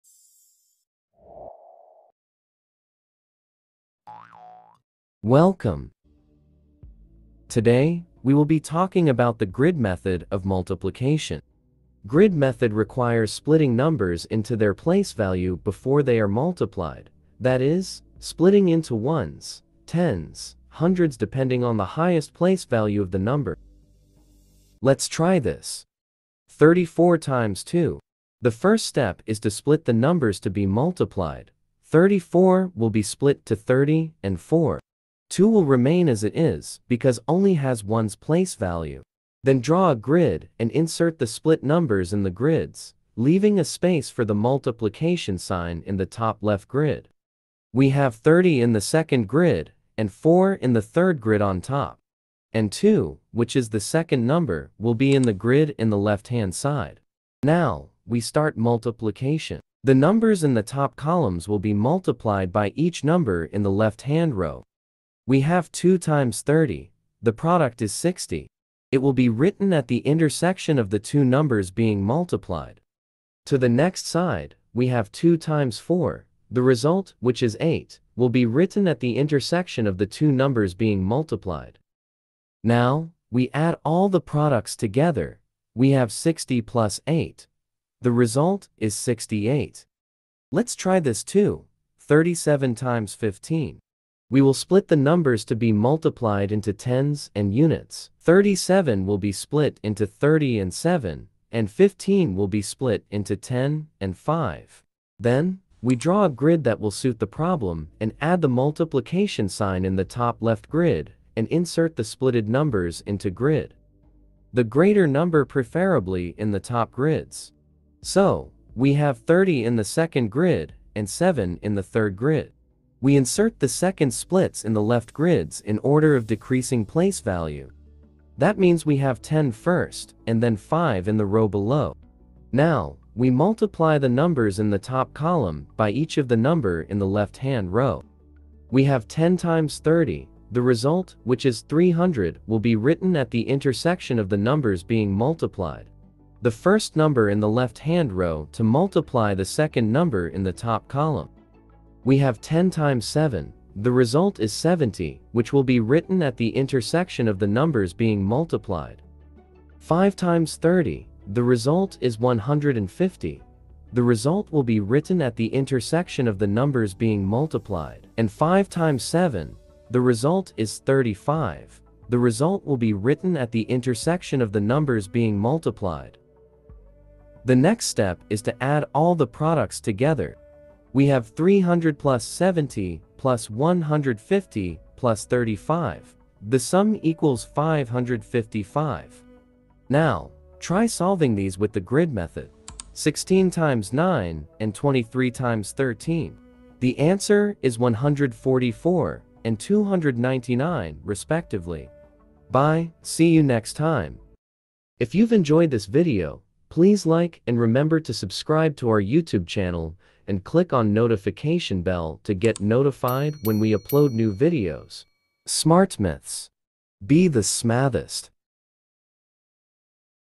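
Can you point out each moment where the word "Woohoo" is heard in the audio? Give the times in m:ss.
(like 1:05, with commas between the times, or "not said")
not said.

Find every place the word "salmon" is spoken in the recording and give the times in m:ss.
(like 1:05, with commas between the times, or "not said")
not said.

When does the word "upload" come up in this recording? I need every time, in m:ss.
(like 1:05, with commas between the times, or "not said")
3:33.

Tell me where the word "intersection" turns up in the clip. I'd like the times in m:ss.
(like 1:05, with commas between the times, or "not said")
1:09, 1:19, 2:23, 2:36, 2:45, 2:53.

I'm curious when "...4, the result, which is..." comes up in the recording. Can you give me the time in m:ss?
1:15.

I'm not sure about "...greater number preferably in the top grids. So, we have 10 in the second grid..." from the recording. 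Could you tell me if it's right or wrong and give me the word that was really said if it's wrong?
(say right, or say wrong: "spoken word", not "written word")
wrong: "30", not "10".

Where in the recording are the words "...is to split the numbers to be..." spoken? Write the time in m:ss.
0:29.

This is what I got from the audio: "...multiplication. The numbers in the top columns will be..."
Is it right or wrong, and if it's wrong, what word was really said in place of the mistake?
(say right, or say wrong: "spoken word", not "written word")
right.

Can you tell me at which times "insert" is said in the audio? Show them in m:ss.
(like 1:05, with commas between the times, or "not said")
0:40, 1:51, 2:03.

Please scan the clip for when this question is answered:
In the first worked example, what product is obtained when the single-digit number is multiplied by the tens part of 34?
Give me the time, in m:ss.
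1:07.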